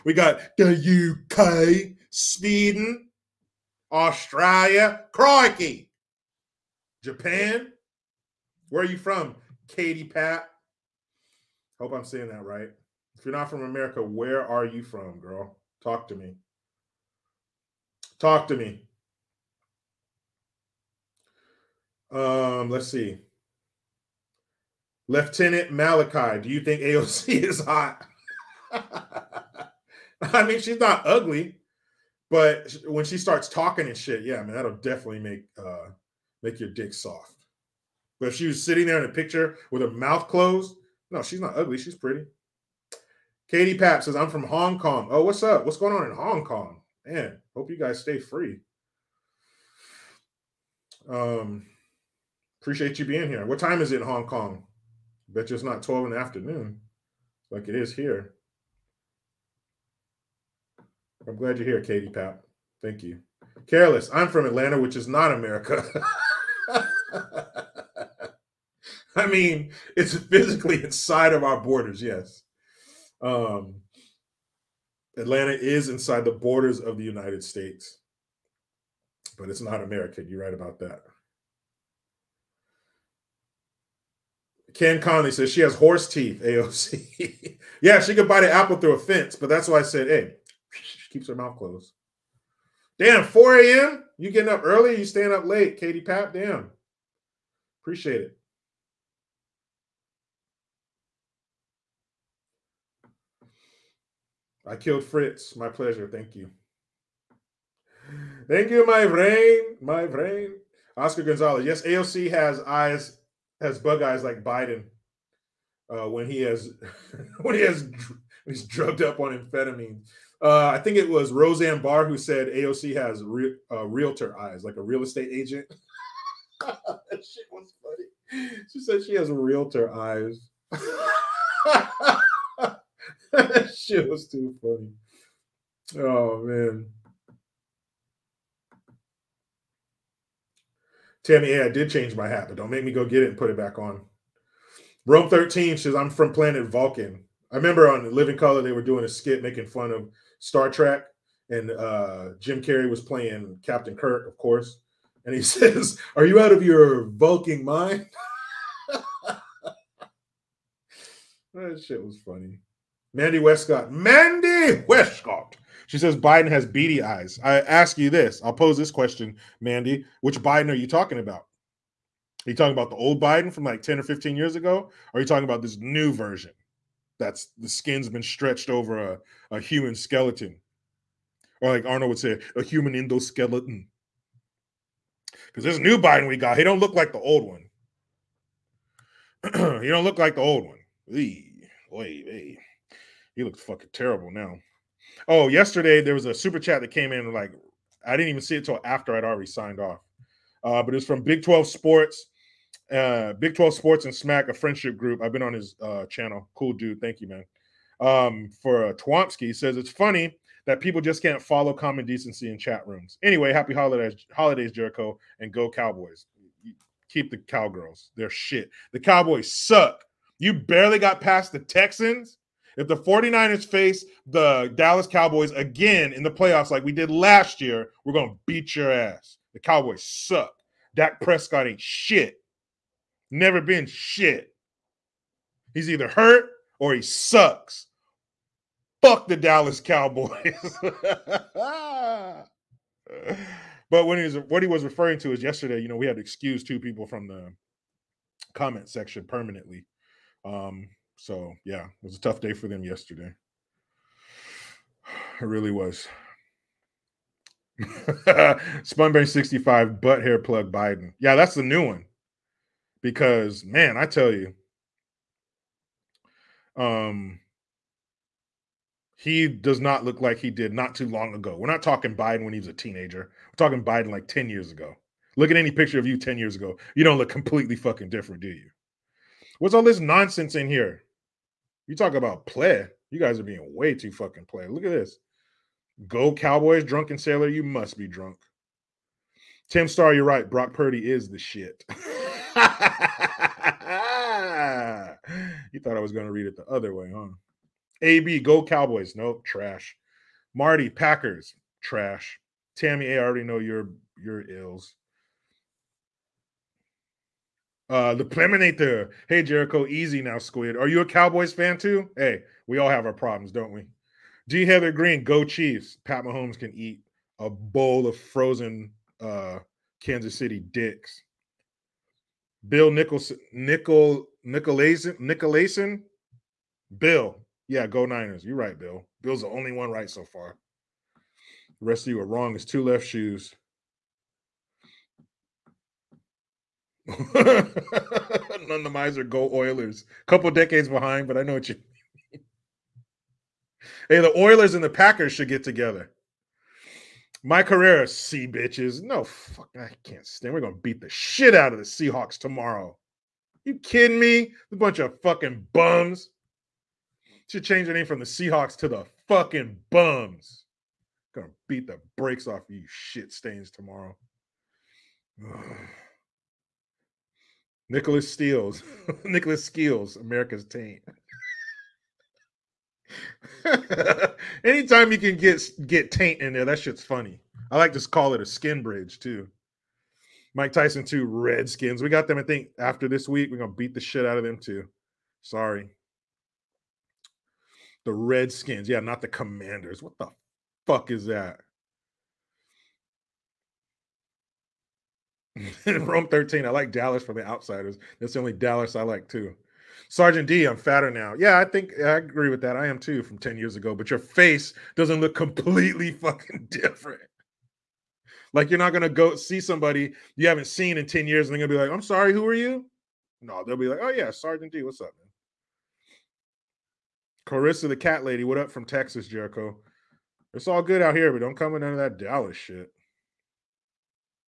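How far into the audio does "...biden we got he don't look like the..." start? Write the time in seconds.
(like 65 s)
185 s.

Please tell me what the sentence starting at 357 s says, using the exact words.
Should change the name from the Seahawks to the fucking bums.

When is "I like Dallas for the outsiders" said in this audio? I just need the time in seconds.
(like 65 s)
396 s.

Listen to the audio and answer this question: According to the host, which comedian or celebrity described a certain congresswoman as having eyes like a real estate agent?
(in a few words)
Roseanne Barr.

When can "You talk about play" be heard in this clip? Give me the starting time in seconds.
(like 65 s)
281 s.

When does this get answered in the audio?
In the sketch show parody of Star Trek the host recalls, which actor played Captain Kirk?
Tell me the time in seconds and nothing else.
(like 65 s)
152 s.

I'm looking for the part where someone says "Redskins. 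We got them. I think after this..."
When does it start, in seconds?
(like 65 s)
381 s.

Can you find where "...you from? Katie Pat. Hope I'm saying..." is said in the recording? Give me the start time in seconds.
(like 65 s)
8 s.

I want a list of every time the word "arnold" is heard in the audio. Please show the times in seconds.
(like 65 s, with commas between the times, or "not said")
181 s.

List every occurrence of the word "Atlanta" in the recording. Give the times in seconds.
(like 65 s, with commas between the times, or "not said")
64 s, 75 s.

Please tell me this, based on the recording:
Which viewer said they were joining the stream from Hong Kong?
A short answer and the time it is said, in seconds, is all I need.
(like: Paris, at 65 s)
Katie Papp, at 43 s.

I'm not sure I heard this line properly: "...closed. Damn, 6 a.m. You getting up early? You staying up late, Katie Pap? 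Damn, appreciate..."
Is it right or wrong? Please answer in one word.
wrong.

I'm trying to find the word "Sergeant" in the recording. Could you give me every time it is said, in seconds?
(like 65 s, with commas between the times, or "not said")
400 s, 414 s.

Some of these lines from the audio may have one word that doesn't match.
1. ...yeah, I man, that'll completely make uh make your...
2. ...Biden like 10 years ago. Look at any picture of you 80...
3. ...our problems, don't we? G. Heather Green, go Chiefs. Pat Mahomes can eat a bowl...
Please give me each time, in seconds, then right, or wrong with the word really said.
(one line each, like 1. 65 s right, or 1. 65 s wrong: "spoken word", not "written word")
1. 34 s wrong: "definitely", not "completely"
2. 273 s wrong: "10", not "80"
3. 313 s right.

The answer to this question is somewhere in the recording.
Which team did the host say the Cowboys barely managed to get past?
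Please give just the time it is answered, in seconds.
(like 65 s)
221 s.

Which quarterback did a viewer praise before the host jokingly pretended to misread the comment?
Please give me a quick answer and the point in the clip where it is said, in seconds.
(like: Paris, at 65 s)
Brock Purdy, at 290 s.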